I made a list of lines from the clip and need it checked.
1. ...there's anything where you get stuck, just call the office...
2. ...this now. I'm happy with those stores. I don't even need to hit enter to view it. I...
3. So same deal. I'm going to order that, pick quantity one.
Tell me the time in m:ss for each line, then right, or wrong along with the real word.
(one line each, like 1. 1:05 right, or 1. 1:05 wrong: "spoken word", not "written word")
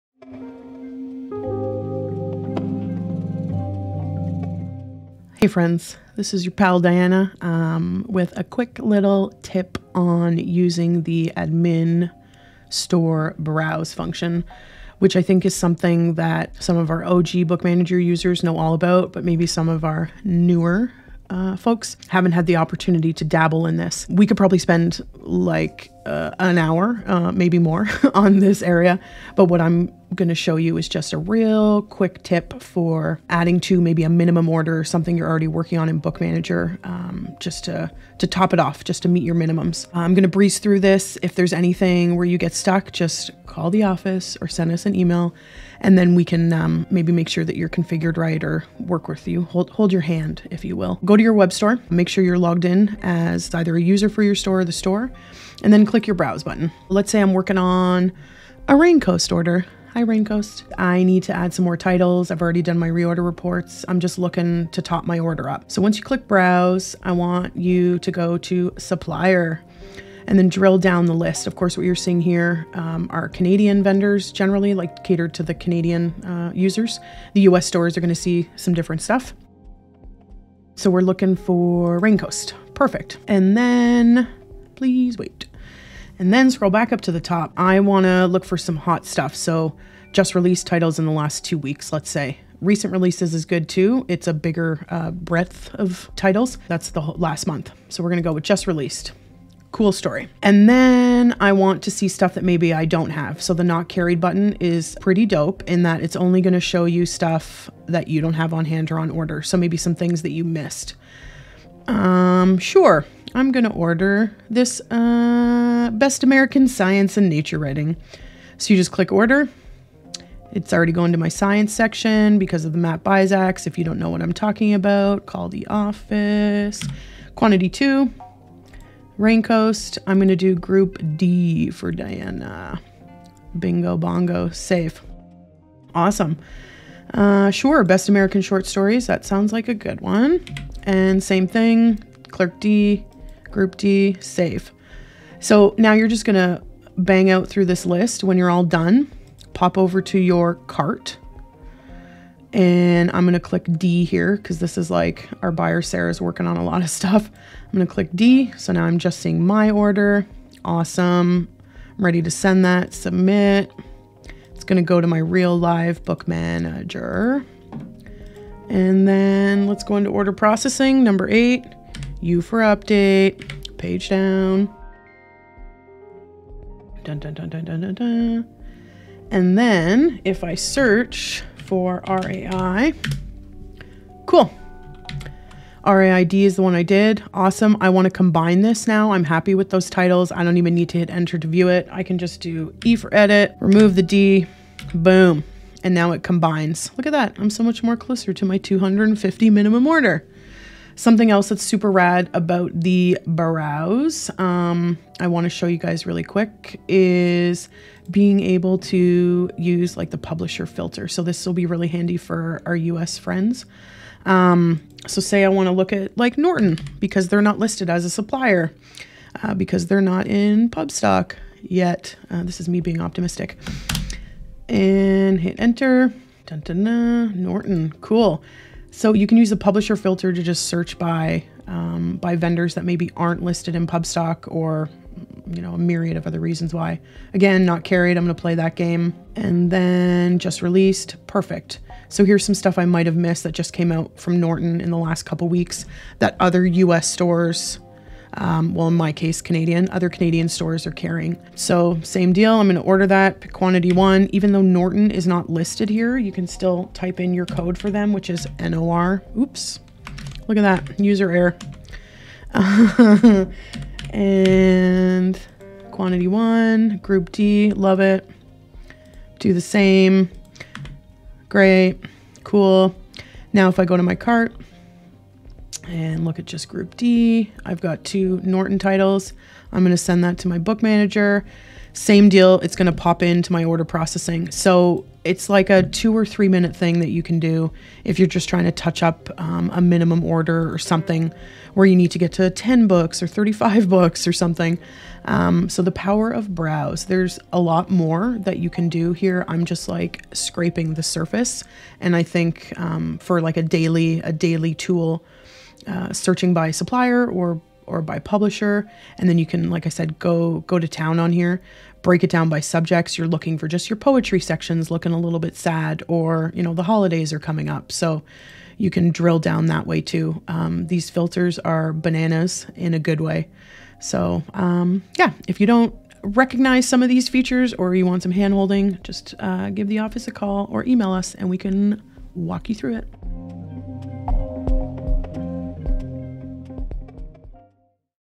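1. 0:41 right
2. 3:08 wrong: "titles", not "stores"
3. 4:11 right.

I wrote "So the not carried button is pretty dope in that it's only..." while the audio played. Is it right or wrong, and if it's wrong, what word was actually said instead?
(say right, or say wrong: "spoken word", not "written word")
right.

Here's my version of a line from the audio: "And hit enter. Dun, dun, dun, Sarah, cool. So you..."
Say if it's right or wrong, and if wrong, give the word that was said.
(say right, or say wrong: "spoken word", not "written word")
wrong: "Norton", not "Sarah".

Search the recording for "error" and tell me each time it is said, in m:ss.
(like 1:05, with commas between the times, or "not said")
4:21.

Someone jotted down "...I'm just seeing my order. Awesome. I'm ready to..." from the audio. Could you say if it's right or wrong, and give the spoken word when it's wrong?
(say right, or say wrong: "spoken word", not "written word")
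right.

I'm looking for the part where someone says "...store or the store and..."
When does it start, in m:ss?
0:54.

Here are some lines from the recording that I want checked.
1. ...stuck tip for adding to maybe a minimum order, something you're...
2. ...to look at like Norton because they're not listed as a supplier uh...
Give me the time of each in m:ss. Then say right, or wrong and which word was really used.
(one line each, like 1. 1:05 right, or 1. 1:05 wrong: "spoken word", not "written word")
1. 0:31 wrong: "quick", not "stuck"
2. 3:35 right.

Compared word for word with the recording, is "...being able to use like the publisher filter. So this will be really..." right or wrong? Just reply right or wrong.
right.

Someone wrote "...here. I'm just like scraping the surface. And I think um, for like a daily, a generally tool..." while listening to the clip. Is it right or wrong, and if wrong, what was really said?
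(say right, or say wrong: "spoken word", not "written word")
wrong: "daily", not "generally".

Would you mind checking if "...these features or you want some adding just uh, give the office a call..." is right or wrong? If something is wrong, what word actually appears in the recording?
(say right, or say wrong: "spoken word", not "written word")
wrong: "handholding", not "adding".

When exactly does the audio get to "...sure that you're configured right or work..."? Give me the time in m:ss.
0:47.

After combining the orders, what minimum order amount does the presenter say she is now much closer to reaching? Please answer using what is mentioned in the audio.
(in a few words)
250.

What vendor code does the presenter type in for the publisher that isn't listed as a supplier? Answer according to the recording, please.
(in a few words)
NOR.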